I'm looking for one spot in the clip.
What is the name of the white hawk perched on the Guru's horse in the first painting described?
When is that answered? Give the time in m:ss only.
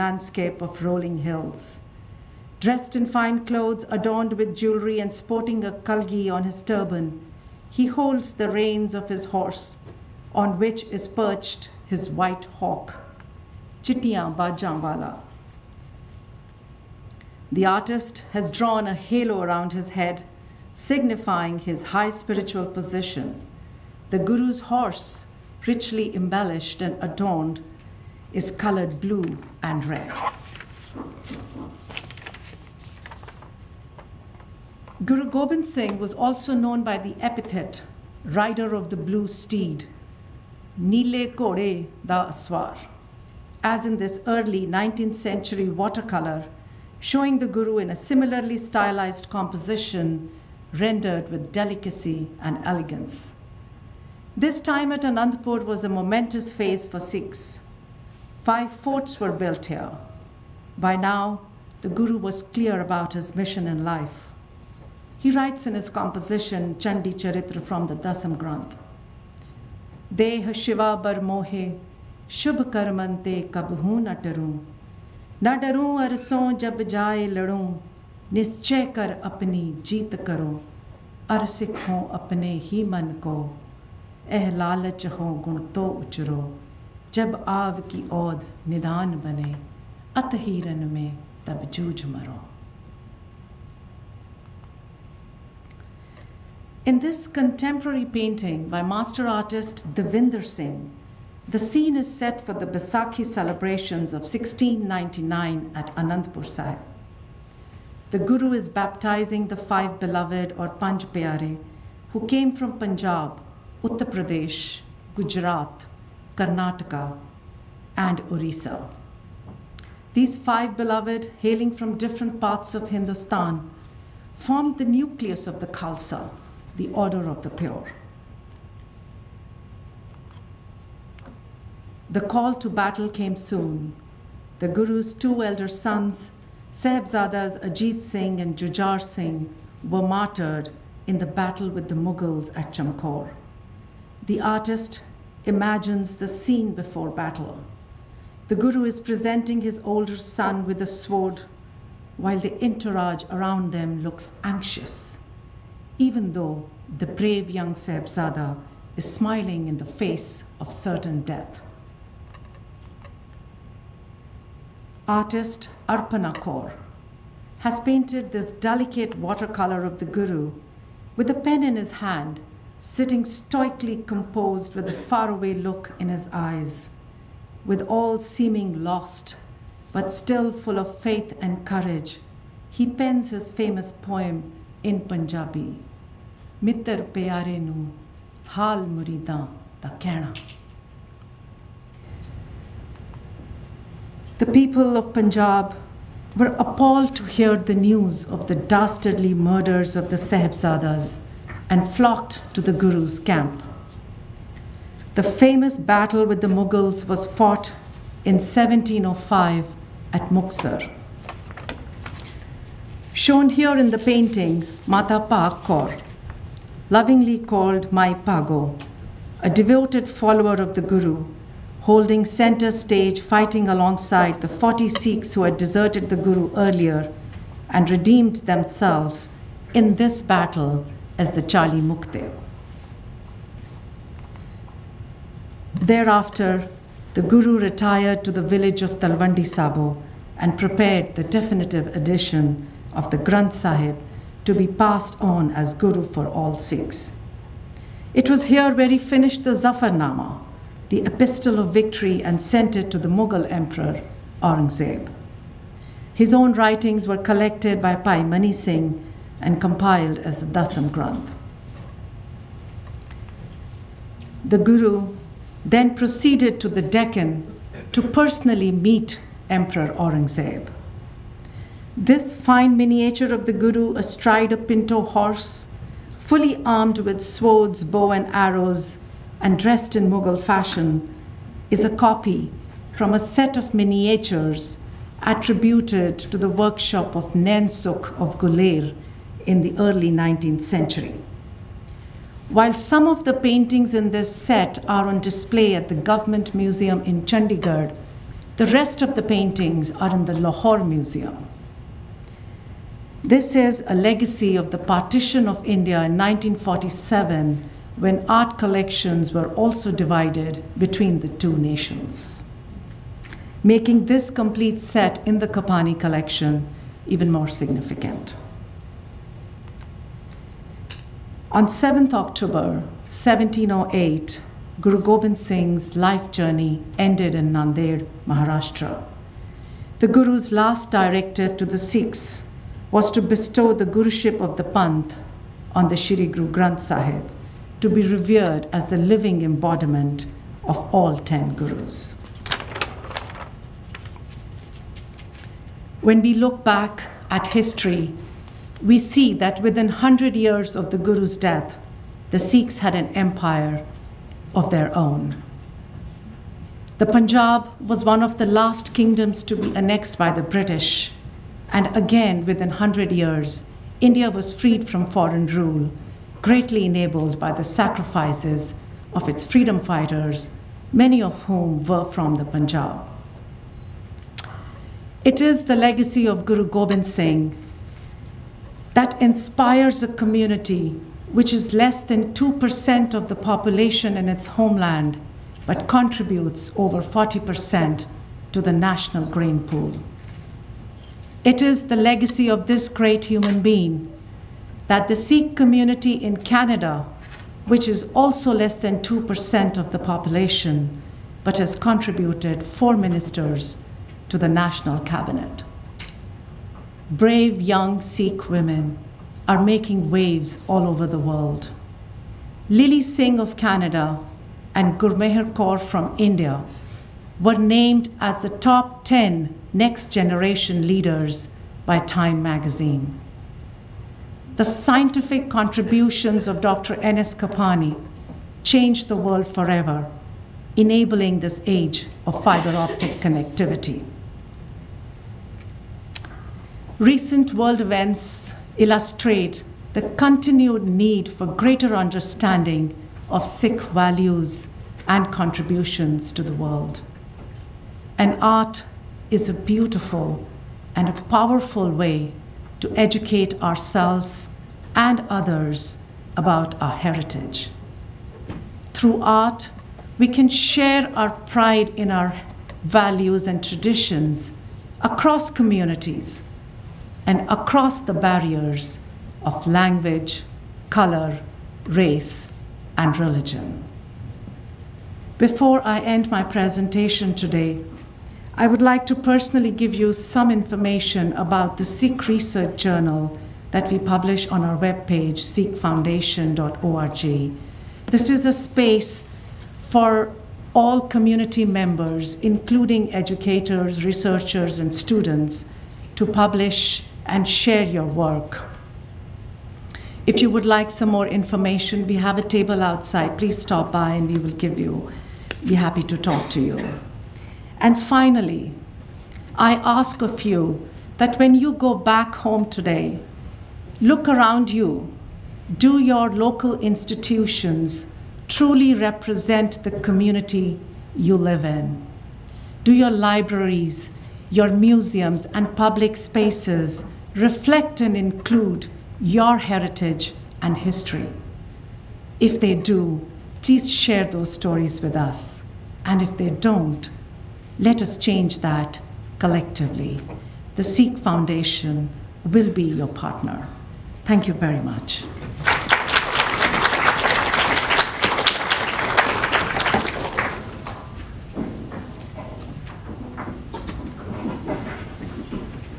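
0:13.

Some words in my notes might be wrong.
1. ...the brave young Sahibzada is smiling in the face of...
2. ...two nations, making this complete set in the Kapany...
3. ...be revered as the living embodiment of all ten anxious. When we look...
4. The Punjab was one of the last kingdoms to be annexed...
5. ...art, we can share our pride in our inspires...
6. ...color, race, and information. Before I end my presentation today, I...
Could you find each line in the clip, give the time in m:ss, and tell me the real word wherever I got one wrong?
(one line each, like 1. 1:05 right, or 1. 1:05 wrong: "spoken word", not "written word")
1. 2:36 right
2. 5:11 right
3. 5:37 wrong: "gurus", not "anxious"
4. 5:56 right
5. 7:39 wrong: "values", not "inspires"
6. 7:50 wrong: "religion", not "information".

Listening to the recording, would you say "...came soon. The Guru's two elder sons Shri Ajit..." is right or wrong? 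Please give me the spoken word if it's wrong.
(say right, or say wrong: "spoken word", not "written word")
wrong: "Sahibzadas", not "Shri".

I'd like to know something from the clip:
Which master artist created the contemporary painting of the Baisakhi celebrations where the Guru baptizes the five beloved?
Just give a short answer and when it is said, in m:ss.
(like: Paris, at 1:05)
Devinder Singh, at 1:39.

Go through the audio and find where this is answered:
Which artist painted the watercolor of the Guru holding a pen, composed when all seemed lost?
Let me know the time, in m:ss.
2:45.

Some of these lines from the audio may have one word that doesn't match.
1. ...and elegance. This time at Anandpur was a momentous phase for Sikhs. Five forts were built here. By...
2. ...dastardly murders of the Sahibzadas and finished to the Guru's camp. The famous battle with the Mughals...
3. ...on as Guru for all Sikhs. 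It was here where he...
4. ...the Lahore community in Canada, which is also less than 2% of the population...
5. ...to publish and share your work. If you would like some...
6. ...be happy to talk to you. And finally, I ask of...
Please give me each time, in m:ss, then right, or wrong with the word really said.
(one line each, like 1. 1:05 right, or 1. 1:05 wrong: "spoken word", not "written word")
1. 0:52 right
2. 3:18 wrong: "flocked", not "finished"
3. 4:05 right
4. 6:35 wrong: "Sikh", not "Lahore"
5. 8:16 right
6. 8:25 right.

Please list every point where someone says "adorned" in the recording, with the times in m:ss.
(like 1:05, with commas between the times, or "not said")
0:03, 0:27.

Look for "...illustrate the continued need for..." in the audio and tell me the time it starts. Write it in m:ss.
7:18.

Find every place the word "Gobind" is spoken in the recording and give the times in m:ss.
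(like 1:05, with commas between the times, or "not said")
0:35, 5:25, 6:16.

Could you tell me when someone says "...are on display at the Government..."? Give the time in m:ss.
4:54.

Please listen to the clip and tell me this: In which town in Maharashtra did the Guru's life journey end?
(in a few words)
Nandir.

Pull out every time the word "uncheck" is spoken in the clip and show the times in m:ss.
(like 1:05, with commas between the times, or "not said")
not said.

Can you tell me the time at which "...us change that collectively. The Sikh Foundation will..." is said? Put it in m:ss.
8:58.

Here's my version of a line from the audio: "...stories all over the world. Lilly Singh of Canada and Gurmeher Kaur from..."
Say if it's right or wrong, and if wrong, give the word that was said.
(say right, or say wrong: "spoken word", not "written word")
wrong: "waves", not "stories".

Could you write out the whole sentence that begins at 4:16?
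His own writings were collected by Bhai Mani Singh and compiled as the Dasam Granth.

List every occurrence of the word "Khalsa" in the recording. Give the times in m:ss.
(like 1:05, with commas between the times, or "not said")
2:05.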